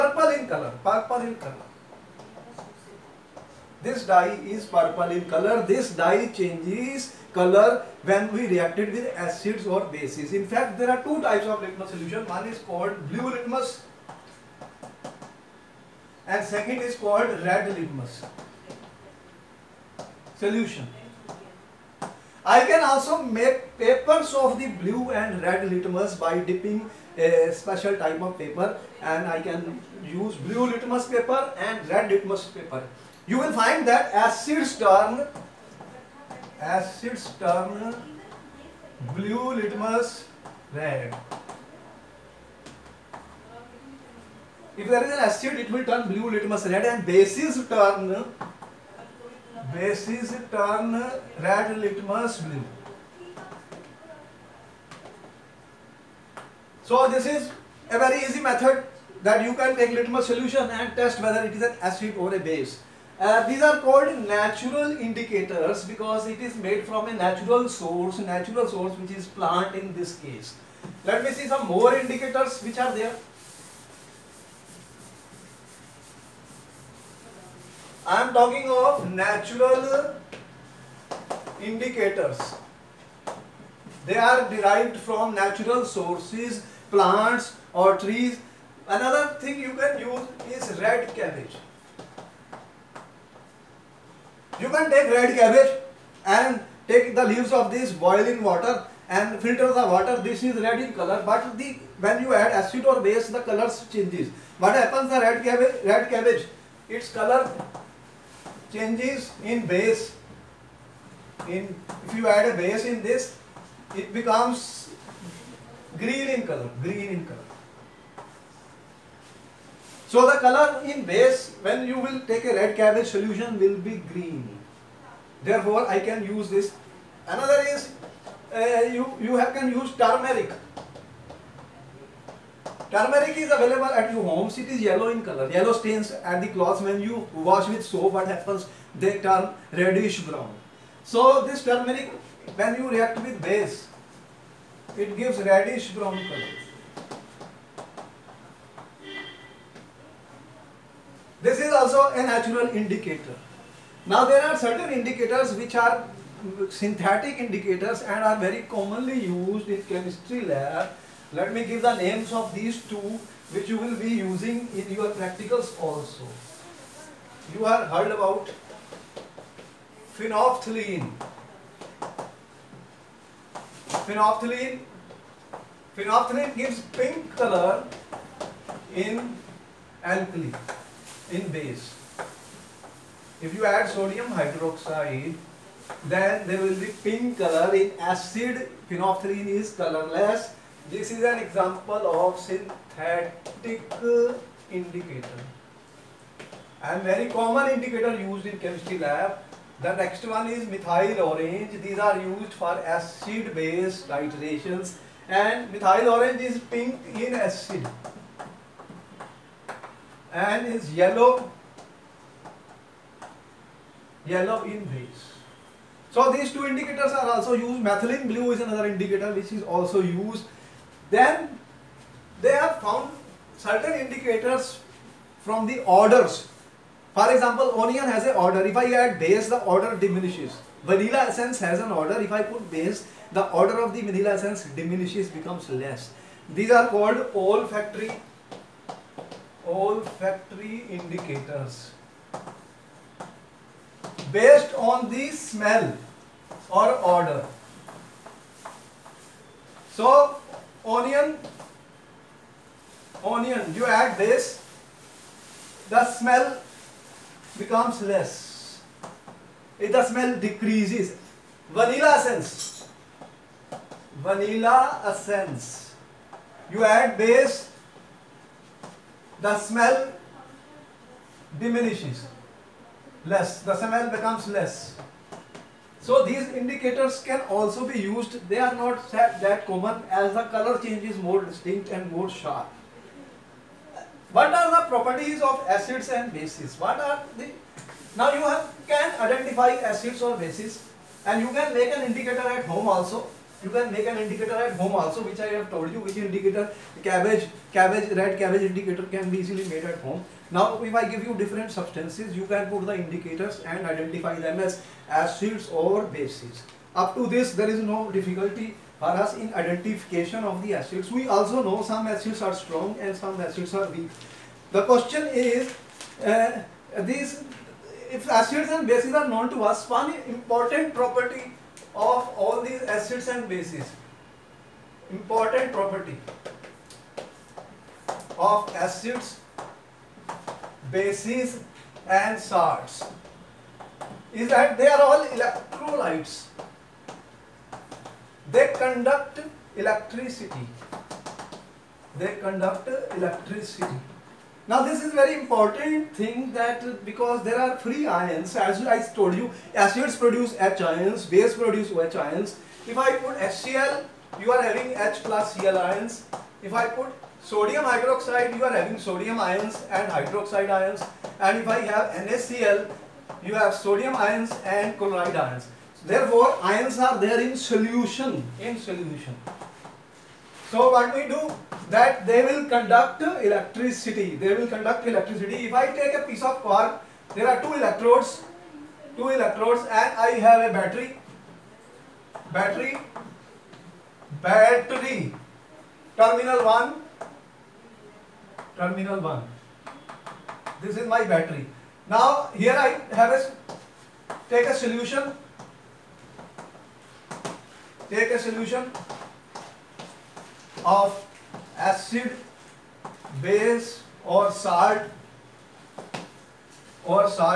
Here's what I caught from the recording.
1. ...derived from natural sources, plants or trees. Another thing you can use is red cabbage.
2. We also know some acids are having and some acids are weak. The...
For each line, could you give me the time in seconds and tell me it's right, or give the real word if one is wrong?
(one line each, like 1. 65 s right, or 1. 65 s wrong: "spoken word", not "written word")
1. 84 s right
2. 311 s wrong: "strong", not "having".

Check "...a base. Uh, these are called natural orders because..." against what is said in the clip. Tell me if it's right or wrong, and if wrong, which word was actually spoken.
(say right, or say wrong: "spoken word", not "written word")
wrong: "indicators", not "orders".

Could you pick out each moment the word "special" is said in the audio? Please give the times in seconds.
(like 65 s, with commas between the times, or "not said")
27 s.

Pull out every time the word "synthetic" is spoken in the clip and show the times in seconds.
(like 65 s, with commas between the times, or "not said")
156 s, 192 s.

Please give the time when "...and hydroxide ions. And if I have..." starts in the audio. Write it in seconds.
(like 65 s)
359 s.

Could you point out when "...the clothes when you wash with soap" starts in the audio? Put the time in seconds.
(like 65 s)
136 s.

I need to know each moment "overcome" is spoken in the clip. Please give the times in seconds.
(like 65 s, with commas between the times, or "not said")
not said.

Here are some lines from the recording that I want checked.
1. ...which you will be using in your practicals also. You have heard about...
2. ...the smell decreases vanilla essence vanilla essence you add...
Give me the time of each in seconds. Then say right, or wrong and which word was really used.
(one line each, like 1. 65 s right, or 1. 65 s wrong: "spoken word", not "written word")
1. 163 s right
2. 259 s right.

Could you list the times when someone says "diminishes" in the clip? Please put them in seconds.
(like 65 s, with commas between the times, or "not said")
230 s, 234 s, 271 s.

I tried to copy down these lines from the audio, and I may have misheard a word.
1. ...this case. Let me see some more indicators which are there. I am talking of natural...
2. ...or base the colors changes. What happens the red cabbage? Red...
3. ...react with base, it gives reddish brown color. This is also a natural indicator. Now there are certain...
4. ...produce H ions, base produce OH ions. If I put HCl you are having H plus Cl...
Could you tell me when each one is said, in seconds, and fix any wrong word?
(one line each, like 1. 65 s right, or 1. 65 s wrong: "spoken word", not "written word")
1. 69 s right
2. 102 s right
3. 142 s right
4. 350 s right.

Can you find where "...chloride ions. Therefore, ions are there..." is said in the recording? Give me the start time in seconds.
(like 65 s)
364 s.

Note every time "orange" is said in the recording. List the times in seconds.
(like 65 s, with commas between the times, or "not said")
201 s, 206 s.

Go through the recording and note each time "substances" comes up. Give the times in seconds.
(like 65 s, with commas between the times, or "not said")
301 s.